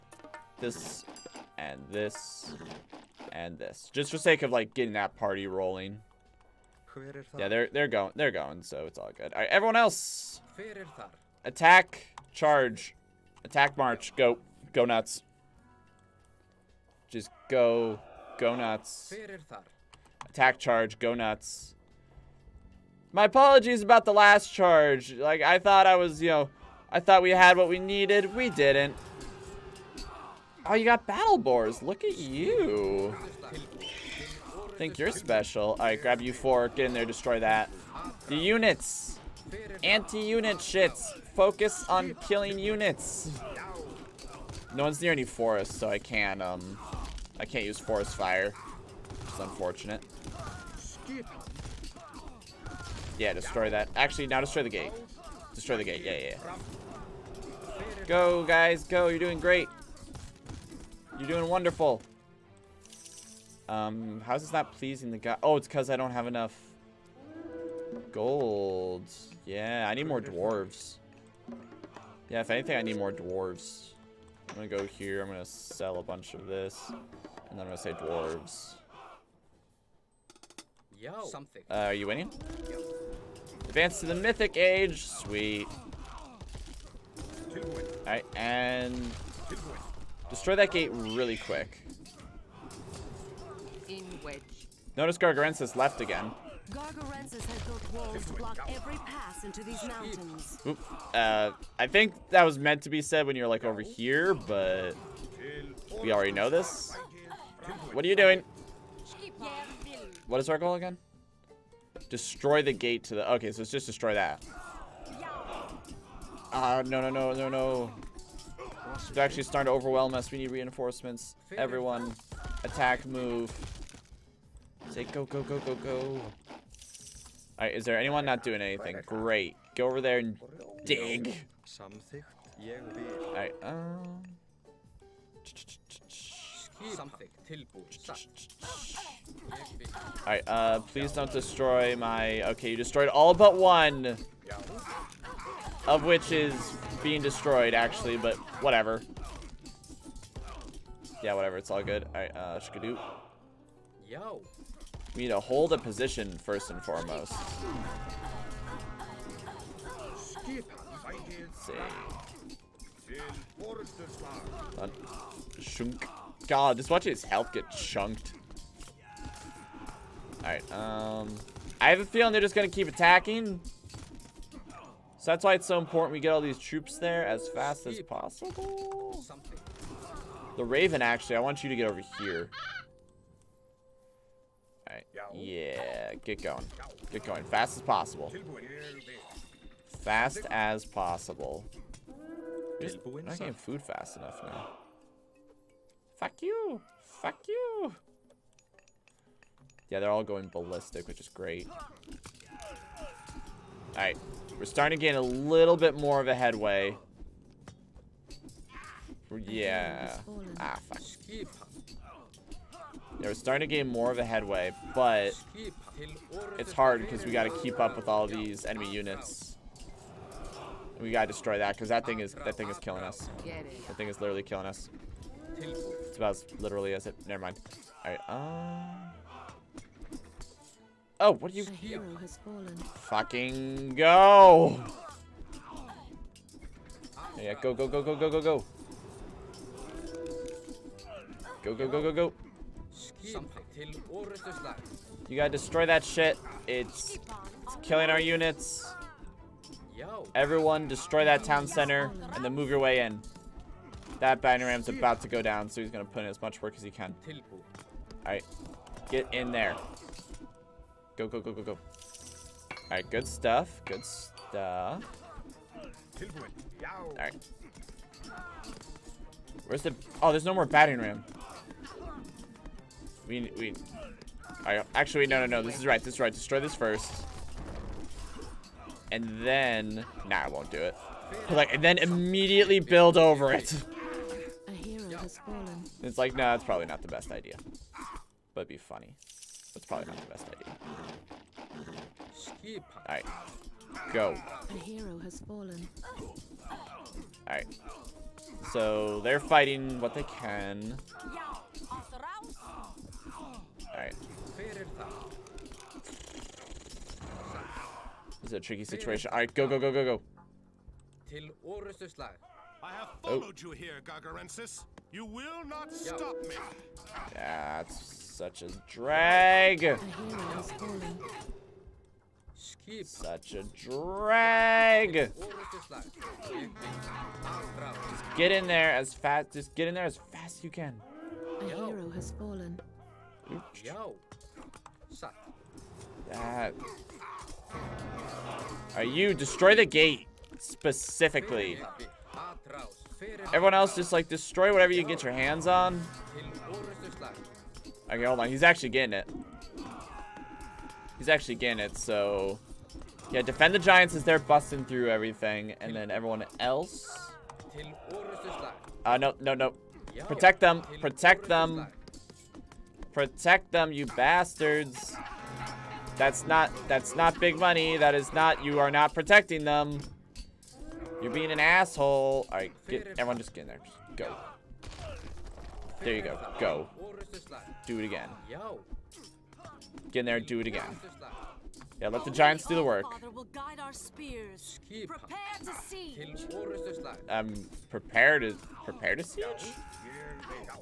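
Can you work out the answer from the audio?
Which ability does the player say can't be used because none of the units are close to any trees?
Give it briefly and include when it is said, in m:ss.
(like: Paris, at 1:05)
Forest fire, at 0:47.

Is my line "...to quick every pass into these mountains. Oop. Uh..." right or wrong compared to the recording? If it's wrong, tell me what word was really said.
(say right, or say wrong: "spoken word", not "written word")
wrong: "block", not "quick".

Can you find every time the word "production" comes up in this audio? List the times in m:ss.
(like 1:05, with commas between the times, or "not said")
not said.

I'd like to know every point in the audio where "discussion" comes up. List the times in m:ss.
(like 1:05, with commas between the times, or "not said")
not said.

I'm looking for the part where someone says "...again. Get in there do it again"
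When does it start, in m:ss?
6:18.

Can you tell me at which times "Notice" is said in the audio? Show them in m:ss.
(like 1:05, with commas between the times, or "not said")
1:34.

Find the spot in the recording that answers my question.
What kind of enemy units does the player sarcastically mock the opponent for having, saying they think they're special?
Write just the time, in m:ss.
0:31.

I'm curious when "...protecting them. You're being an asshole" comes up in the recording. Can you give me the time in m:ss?
6:09.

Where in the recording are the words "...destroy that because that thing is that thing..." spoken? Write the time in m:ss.
3:41.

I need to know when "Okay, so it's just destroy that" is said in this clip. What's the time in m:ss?
1:53.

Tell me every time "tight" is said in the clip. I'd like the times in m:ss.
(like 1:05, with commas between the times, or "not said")
not said.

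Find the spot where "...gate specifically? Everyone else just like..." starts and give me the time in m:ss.
5:39.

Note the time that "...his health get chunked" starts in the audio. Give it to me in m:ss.
2:47.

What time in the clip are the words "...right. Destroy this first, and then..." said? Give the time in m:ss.
4:36.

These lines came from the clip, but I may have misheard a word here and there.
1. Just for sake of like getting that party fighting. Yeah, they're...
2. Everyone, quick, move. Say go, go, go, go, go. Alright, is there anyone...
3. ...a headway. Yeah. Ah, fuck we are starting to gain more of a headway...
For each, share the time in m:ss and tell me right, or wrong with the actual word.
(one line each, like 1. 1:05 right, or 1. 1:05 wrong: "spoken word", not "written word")
1. 0:03 wrong: "rolling", not "fighting"
2. 2:01 wrong: "attack", not "quick"
3. 3:26 right.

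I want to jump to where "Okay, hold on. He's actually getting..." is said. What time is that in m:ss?
5:48.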